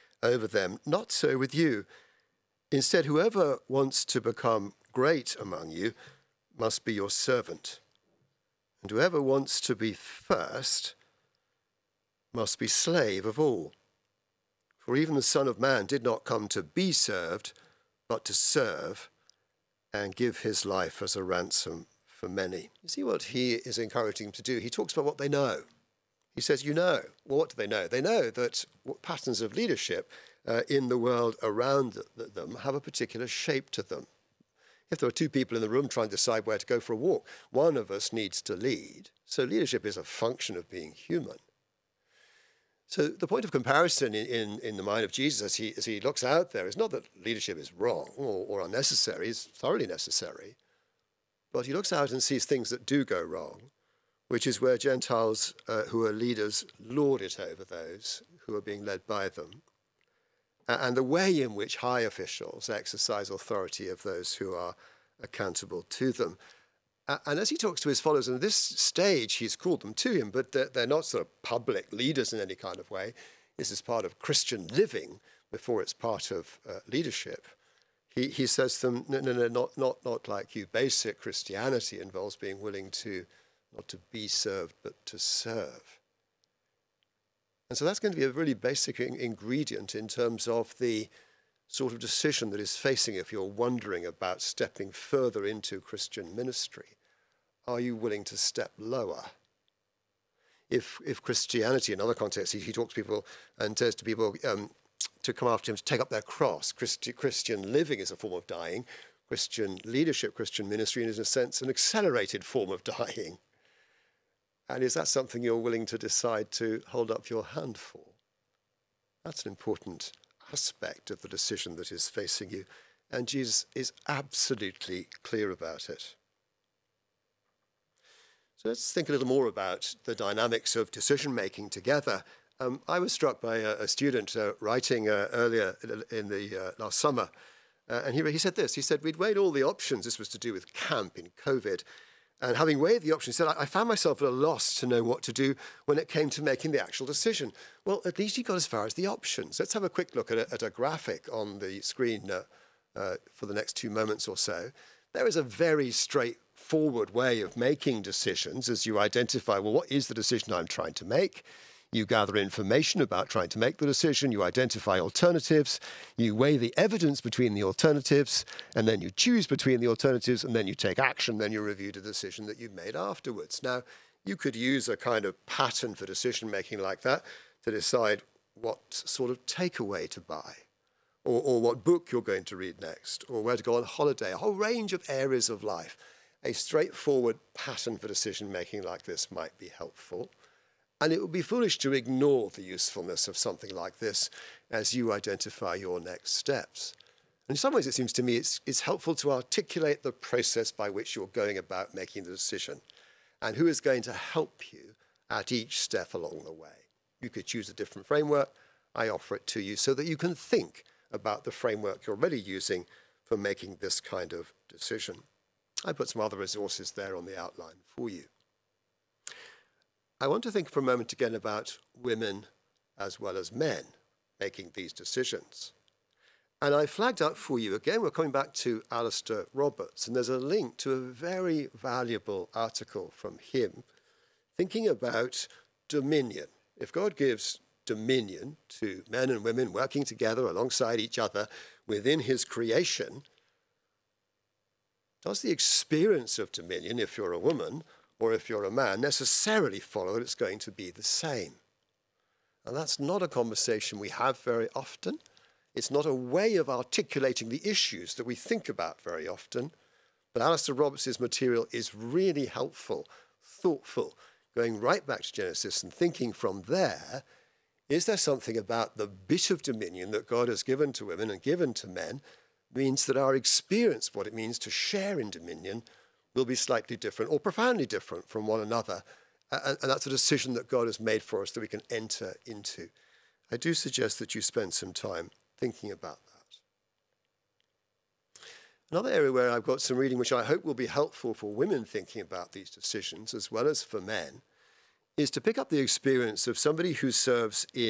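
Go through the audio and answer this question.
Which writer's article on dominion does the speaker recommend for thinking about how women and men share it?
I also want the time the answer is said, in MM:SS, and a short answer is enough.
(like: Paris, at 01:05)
Alastair Roberts, at 03:48.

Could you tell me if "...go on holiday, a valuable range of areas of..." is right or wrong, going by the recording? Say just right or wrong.
wrong.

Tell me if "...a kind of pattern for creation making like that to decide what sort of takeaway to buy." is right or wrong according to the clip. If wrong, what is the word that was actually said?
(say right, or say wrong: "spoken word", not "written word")
wrong: "decision", not "creation".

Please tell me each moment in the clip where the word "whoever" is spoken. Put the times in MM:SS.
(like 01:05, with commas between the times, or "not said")
00:03, 00:08.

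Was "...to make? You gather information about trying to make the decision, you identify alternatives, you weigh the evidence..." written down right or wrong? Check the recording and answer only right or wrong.
right.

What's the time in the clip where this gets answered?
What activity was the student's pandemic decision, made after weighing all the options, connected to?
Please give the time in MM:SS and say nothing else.
02:20.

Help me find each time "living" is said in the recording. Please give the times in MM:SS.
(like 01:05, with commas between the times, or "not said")
01:14, 01:47.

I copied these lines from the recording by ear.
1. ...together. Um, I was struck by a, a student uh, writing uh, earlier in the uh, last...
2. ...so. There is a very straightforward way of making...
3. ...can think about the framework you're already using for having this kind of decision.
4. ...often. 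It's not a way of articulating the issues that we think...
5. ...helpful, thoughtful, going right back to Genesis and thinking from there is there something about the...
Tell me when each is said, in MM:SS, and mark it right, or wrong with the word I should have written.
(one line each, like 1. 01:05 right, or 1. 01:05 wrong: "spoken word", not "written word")
1. 02:11 right
2. 02:34 right
3. 03:30 wrong: "making", not "having"
4. 04:14 right
5. 04:22 right.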